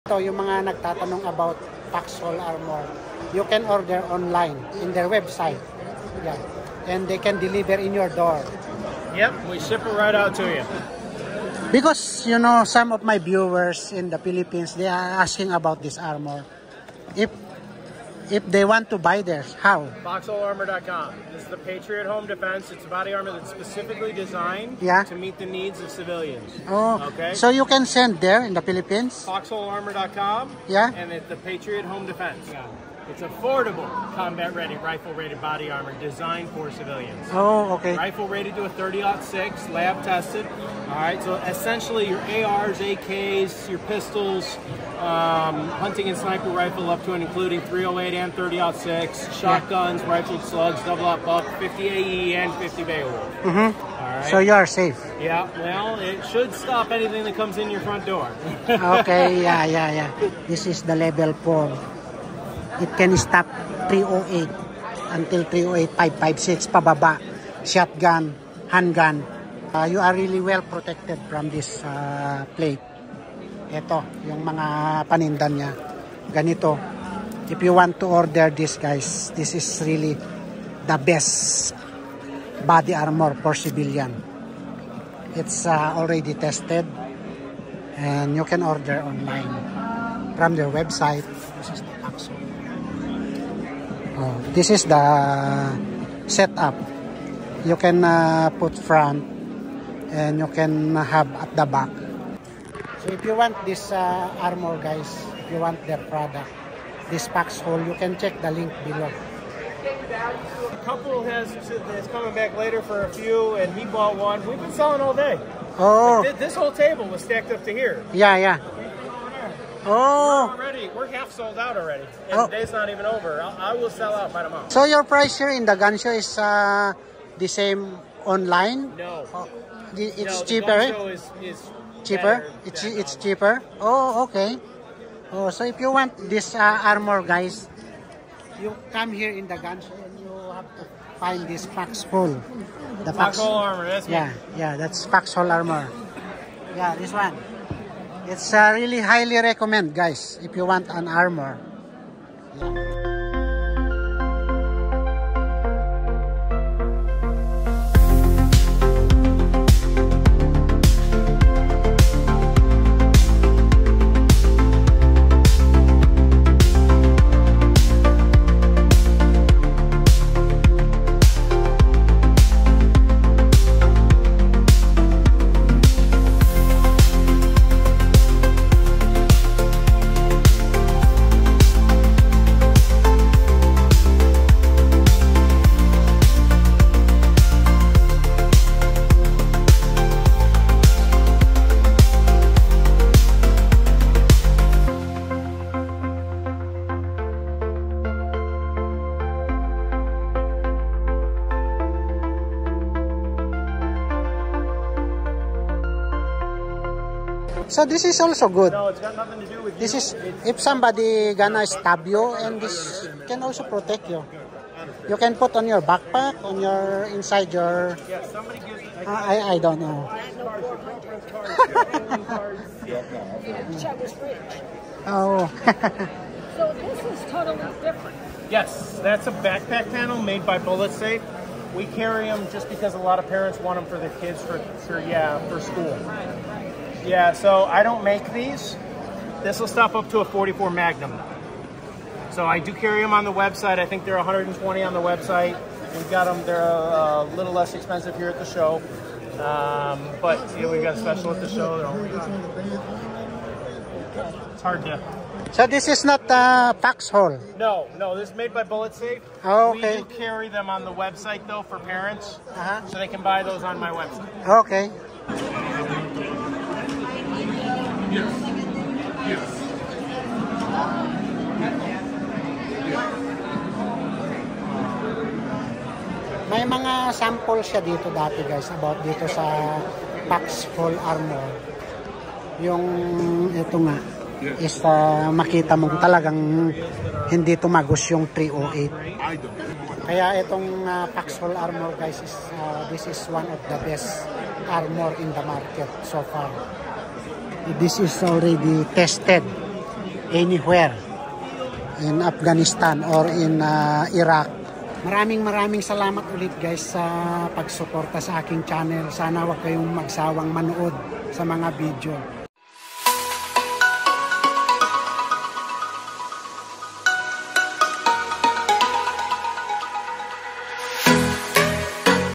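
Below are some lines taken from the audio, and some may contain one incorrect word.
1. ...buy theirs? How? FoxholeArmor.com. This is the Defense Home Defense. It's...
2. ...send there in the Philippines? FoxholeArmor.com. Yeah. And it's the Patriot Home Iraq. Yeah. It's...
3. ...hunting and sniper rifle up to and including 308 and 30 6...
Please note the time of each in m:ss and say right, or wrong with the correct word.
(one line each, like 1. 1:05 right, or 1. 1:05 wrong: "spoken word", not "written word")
1. 0:18 wrong: "Patriot", not "Defense"
2. 0:27 wrong: "Defense", not "Iraq"
3. 0:45 right.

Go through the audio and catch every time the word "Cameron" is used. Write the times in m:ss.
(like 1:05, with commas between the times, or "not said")
not said.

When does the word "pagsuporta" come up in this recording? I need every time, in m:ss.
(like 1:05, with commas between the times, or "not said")
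5:07.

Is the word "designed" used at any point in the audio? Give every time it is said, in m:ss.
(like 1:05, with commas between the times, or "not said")
0:24, 0:35.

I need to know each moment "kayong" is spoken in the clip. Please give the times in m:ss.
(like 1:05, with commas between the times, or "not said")
5:09.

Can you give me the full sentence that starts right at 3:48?
Yes, that's a backpack panel made by BulletSafe.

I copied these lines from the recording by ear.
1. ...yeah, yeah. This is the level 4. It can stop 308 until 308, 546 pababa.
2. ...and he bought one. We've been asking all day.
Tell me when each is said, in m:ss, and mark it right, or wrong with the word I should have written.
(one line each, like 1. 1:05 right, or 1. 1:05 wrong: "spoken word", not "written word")
1. 0:59 wrong: "556", not "546"
2. 1:53 wrong: "selling", not "asking".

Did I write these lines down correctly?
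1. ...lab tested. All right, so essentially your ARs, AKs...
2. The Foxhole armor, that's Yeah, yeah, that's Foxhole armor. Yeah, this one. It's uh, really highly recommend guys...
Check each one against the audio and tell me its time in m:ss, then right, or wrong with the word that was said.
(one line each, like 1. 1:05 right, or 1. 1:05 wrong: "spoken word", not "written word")
1. 0:39 right
2. 2:23 right.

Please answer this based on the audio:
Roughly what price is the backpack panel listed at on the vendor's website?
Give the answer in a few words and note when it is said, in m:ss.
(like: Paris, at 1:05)
120, at 4:04.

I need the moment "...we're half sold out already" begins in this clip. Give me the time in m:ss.
2:00.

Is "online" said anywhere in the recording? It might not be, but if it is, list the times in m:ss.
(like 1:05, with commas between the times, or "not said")
0:04, 1:29, 2:08.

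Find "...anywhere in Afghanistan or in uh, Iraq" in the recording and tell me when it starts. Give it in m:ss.
5:00.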